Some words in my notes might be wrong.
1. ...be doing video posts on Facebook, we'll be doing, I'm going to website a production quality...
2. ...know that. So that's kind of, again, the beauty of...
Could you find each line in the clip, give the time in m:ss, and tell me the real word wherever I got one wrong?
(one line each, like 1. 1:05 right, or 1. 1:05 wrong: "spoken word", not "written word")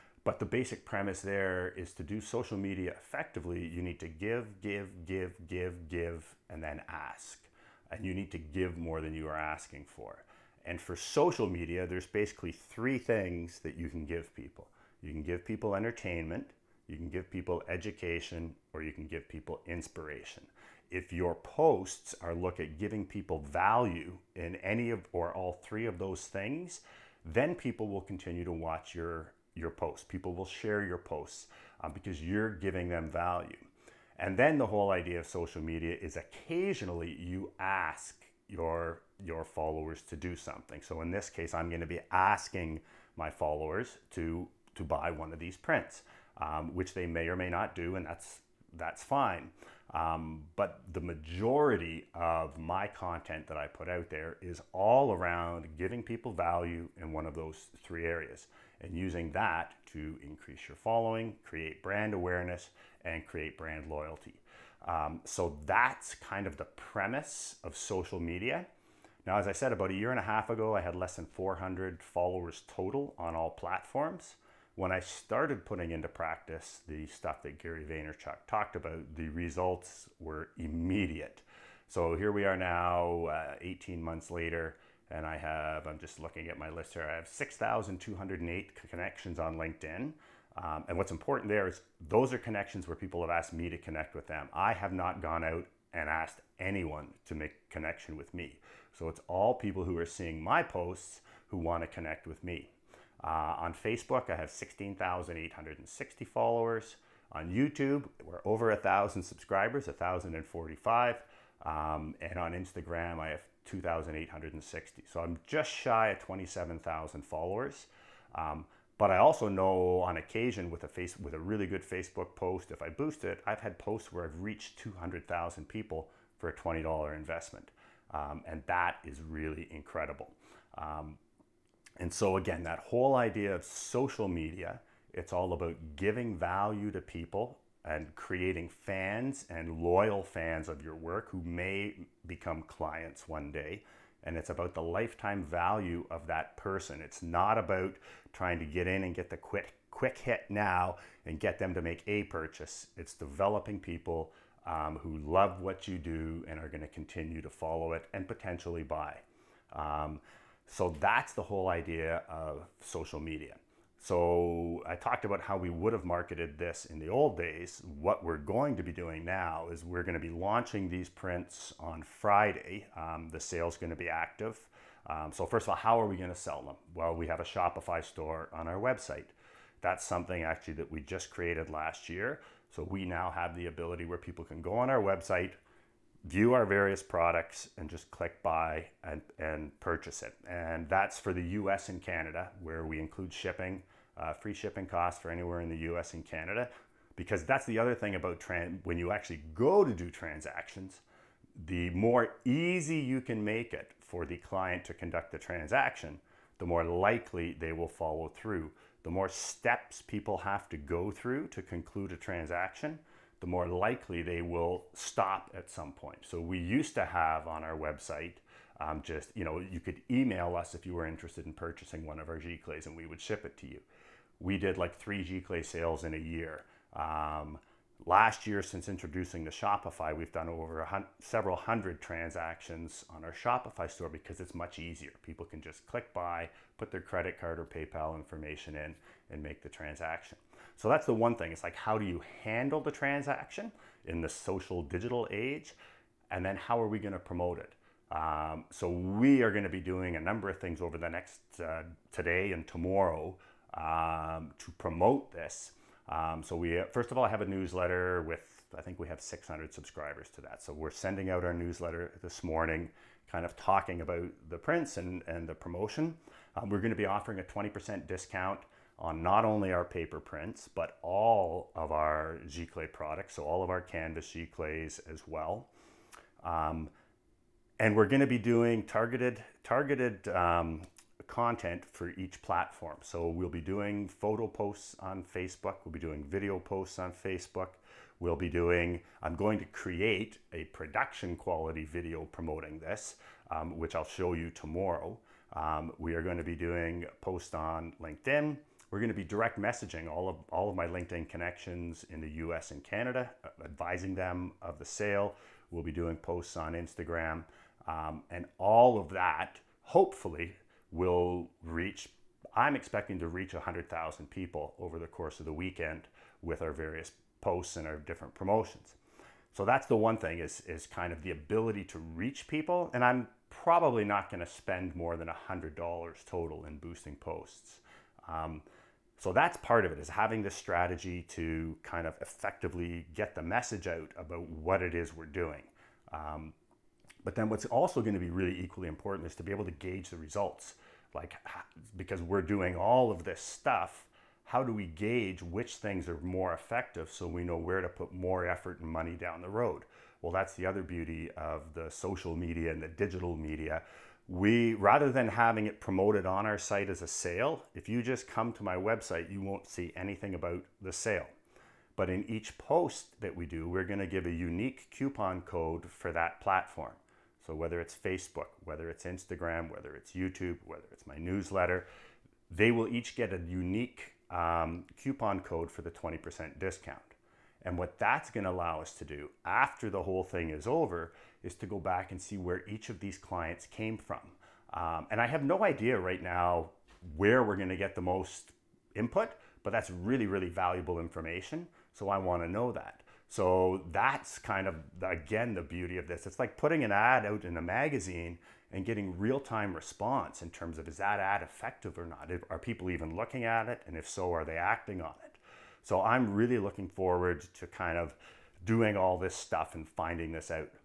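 1. 4:45 wrong: "create", not "website"
2. 6:32 right.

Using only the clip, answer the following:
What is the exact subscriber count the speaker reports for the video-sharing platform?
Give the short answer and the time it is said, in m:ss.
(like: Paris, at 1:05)
1,045, at 1:49.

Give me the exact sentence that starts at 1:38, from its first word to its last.
So it's all people who are seeing my posts who want to connect with me.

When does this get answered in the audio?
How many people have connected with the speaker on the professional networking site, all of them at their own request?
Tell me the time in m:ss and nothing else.
1:27.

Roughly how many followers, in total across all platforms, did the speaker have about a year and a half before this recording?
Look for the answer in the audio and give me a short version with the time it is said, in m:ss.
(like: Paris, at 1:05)
less than 400, at 1:10.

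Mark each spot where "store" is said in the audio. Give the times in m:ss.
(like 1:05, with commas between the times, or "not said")
2:58, 3:53.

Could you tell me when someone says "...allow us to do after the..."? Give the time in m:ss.
6:18.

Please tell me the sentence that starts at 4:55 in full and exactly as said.
Um, we are going to be doing posts on LinkedIn.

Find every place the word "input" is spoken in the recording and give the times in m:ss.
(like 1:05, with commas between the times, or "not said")
6:28.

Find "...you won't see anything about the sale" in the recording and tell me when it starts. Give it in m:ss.
5:59.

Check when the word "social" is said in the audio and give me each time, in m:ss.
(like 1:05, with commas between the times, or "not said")
0:02, 0:10, 0:35, 1:07, 2:13, 2:42, 4:04, 5:51.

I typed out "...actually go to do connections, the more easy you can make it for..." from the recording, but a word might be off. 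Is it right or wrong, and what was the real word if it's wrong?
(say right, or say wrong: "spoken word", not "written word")
wrong: "transactions", not "connections".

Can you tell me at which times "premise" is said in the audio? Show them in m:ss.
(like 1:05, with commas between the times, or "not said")
0:00, 1:06.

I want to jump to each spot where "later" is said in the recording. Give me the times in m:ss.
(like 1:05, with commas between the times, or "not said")
1:24.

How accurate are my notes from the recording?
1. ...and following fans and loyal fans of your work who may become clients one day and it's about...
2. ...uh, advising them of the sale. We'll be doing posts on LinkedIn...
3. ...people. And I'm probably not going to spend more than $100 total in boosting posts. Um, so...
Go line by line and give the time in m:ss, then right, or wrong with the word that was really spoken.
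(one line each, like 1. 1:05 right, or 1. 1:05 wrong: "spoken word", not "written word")
1. 2:17 wrong: "creating", not "following"
2. 5:03 wrong: "Instagram", not "LinkedIn"
3. 5:22 right.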